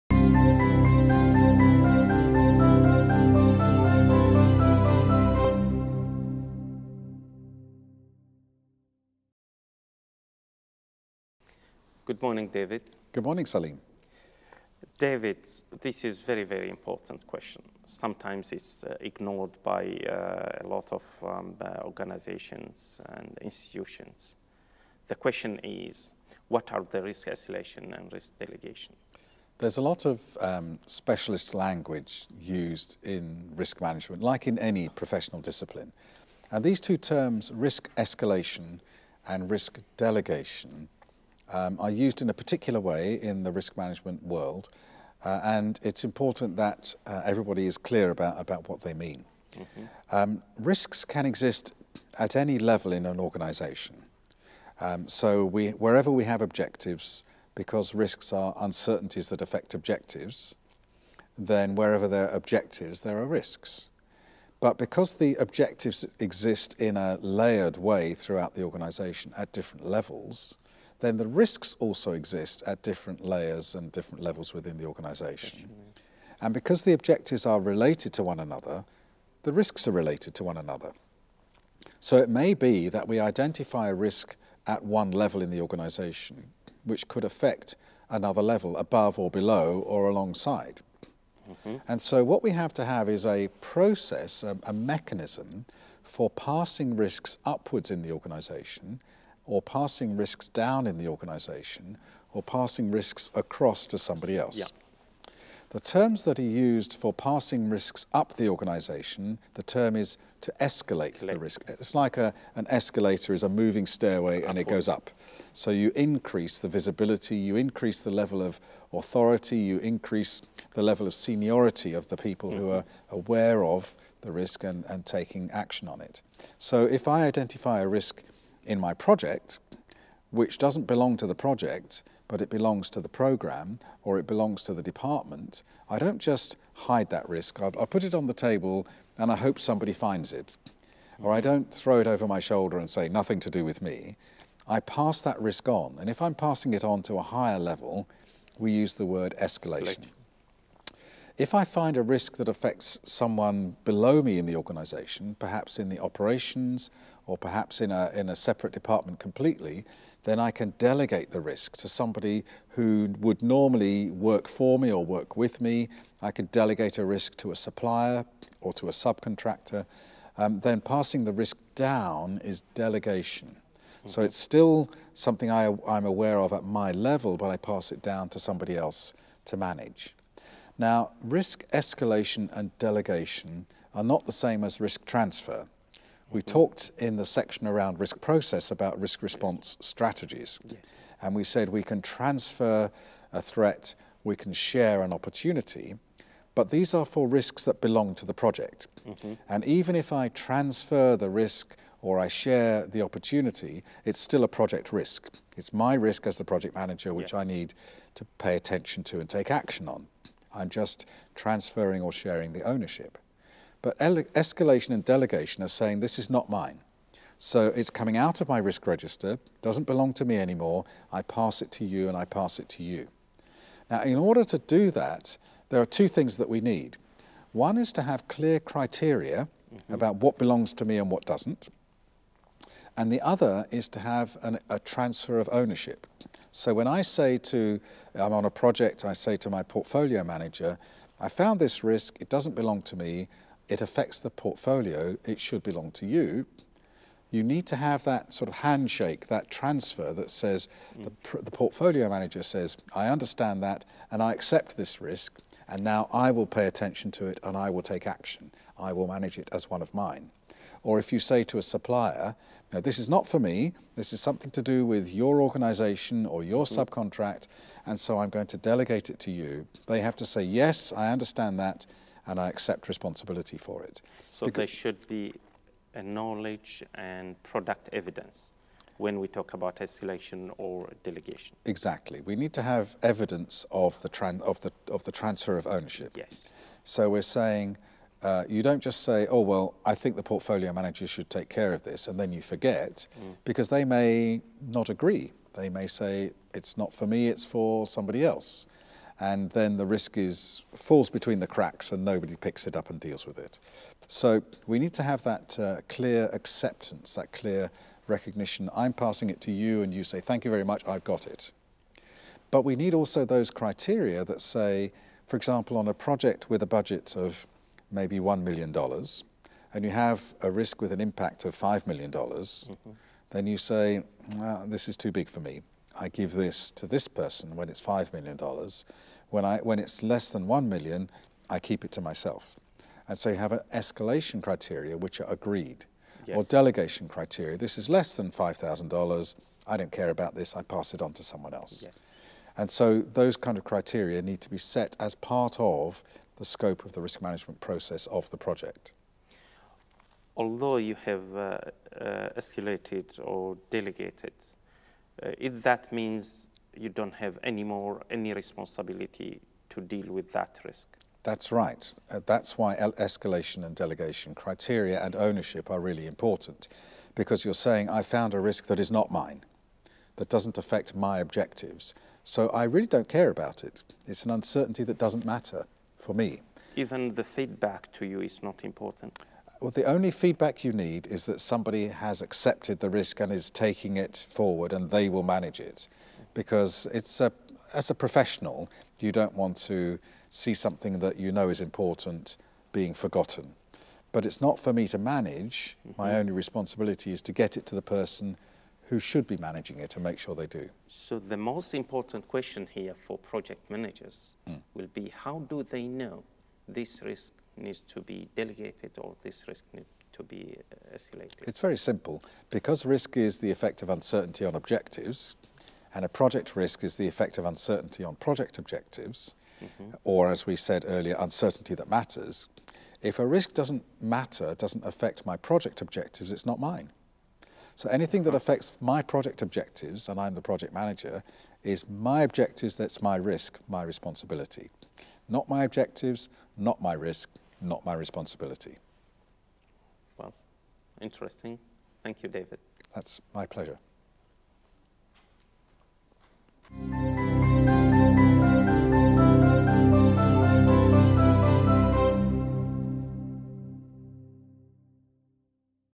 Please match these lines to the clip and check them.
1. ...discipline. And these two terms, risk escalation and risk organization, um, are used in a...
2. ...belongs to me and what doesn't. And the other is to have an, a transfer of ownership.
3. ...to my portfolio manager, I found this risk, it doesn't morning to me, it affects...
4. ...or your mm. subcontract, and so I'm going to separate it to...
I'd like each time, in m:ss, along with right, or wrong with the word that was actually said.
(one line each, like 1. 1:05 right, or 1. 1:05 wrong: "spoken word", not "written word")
1. 0:35 wrong: "delegation", not "organization"
2. 3:50 right
3. 3:59 wrong: "belong", not "morning"
4. 4:26 wrong: "delegate", not "separate".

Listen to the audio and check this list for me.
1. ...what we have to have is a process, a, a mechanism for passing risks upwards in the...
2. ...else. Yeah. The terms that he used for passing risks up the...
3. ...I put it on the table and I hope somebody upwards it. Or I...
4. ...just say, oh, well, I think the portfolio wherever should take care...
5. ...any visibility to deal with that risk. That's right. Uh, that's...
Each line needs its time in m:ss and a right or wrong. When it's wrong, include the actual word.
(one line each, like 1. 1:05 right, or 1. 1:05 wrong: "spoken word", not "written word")
1. 1:32 right
2. 1:44 right
3. 2:17 wrong: "finds", not "upwards"
4. 4:48 wrong: "manager", not "wherever"
5. 5:58 wrong: "responsibility", not "visibility".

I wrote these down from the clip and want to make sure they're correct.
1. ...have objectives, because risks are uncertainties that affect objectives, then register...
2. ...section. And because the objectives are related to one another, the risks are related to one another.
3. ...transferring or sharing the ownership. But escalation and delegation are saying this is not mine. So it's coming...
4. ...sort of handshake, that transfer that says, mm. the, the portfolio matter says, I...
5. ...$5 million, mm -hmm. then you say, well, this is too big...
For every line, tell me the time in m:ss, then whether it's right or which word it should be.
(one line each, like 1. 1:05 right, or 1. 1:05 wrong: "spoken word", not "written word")
1. 0:56 wrong: "wherever", not "register"
2. 1:14 wrong: "organisation", not "section"
3. 3:31 right
4. 4:08 wrong: "manager", not "matter"
5. 5:21 right.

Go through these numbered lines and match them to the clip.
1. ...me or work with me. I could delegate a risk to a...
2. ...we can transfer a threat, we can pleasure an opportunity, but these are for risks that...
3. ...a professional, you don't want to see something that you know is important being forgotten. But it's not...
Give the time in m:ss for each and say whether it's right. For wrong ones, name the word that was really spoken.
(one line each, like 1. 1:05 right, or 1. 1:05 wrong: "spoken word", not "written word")
1. 2:44 right
2. 3:11 wrong: "share", not "pleasure"
3. 6:27 right.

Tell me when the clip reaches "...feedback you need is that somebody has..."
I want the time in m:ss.
6:20.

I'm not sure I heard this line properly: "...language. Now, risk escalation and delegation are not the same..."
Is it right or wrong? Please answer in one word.
wrong.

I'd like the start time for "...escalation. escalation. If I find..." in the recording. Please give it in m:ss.
2:29.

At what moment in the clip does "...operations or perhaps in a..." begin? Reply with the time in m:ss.
2:35.